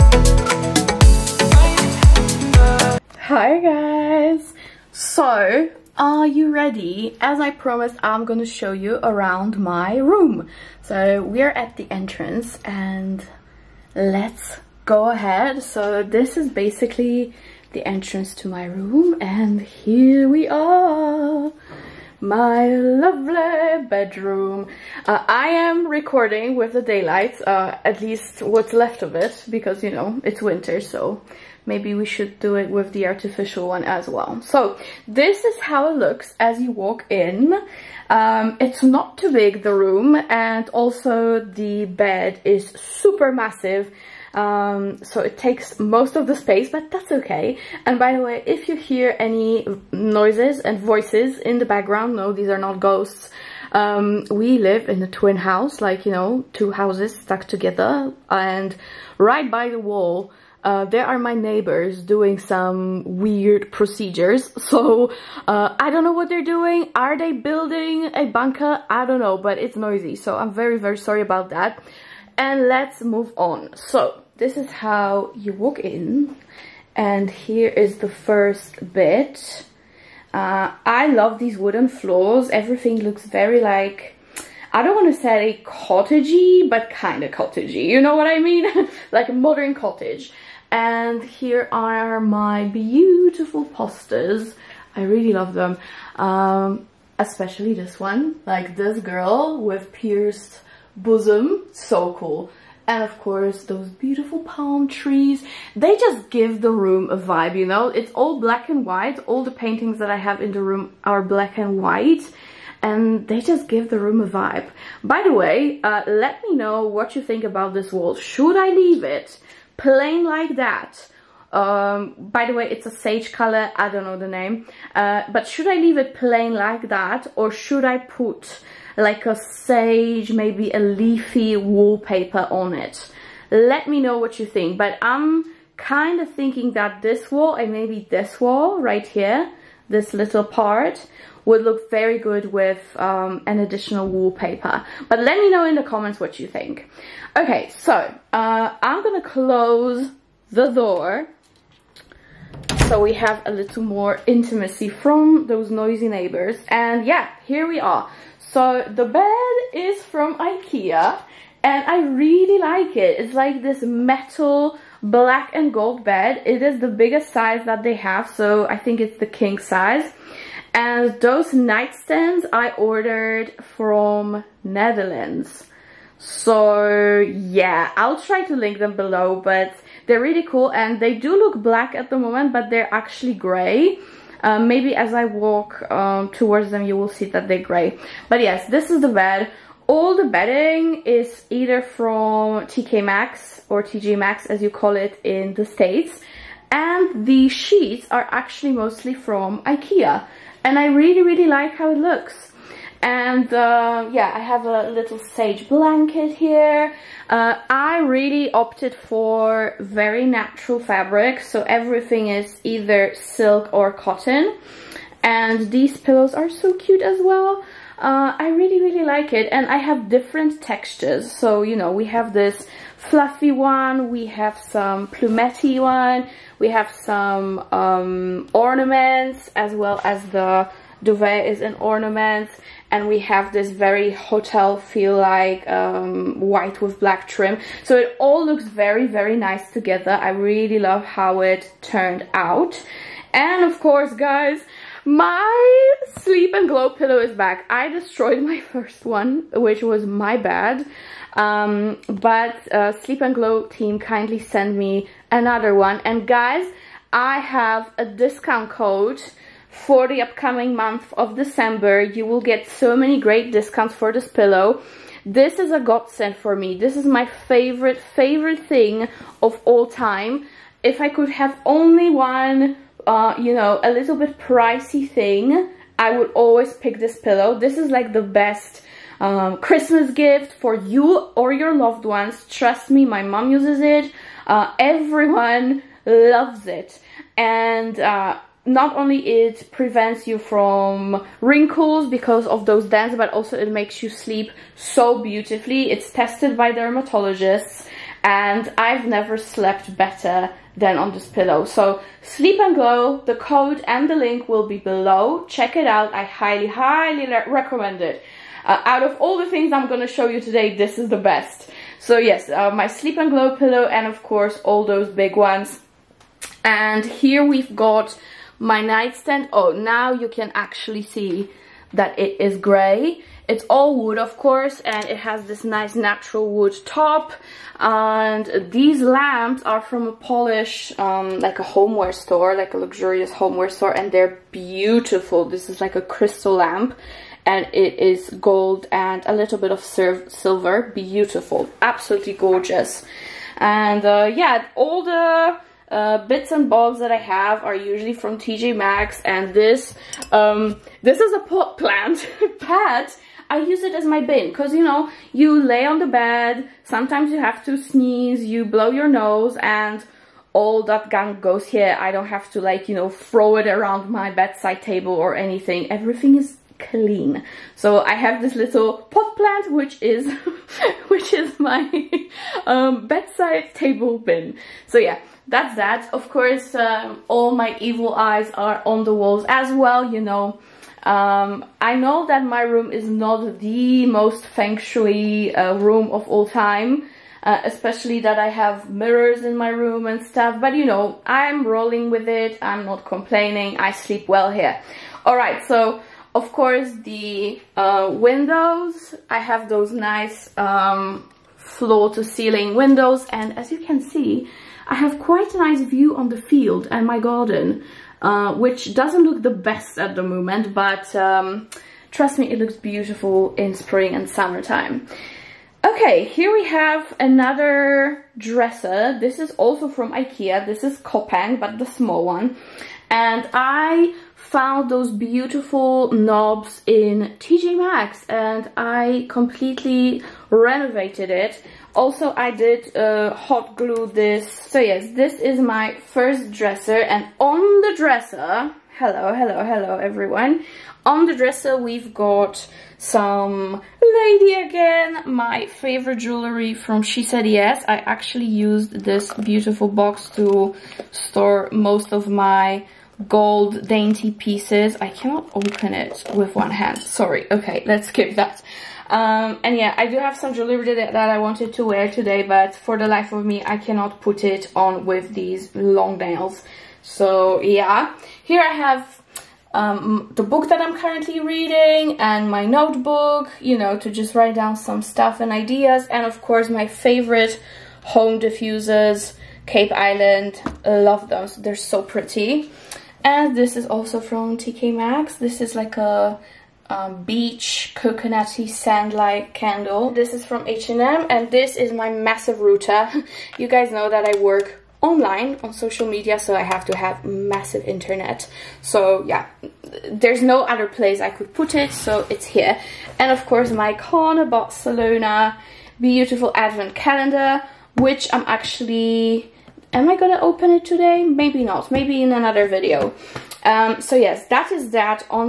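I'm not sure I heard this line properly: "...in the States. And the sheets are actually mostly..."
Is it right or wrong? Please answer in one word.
right.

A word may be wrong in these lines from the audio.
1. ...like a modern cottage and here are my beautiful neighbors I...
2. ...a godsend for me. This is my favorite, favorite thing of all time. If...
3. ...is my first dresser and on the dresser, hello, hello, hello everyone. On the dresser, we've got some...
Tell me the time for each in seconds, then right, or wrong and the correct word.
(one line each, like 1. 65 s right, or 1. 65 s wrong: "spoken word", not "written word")
1. 89 s wrong: "posters", not "neighbors"
2. 265 s right
3. 435 s right.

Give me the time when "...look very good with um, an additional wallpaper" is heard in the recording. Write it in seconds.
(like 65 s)
141 s.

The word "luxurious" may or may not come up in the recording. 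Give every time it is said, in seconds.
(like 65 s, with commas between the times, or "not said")
332 s.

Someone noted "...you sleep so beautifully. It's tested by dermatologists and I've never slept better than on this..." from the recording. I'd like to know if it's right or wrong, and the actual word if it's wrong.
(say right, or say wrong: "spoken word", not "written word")
right.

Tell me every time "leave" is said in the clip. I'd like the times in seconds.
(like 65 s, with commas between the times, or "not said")
118 s, 125 s.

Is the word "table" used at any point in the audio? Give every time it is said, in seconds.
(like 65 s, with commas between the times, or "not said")
364 s, 373 s.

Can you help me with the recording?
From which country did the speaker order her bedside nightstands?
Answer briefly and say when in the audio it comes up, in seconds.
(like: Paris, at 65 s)
Netherlands, at 174 s.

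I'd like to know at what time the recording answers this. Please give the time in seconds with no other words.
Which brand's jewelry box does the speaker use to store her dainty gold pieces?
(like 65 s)
447 s.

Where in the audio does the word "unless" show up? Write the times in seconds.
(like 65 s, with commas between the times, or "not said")
not said.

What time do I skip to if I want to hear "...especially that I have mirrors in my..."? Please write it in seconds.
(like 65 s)
387 s.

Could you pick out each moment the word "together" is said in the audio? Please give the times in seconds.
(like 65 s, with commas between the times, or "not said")
57 s, 239 s.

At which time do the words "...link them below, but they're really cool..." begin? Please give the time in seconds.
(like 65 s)
178 s.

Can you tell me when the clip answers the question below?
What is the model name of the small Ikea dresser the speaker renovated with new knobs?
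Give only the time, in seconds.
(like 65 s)
420 s.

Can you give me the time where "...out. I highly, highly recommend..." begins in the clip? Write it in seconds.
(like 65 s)
305 s.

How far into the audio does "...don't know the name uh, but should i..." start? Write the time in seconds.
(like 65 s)
123 s.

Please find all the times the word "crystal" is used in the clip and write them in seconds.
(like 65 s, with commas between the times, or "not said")
335 s.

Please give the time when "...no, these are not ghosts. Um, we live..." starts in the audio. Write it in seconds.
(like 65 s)
52 s.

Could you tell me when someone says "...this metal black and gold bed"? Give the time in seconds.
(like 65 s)
163 s.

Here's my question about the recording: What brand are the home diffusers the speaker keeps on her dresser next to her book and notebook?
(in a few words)
Cape Island.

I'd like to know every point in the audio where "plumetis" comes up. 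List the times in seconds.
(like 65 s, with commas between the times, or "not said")
225 s.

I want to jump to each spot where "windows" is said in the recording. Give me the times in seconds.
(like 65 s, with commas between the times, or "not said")
398 s, 402 s.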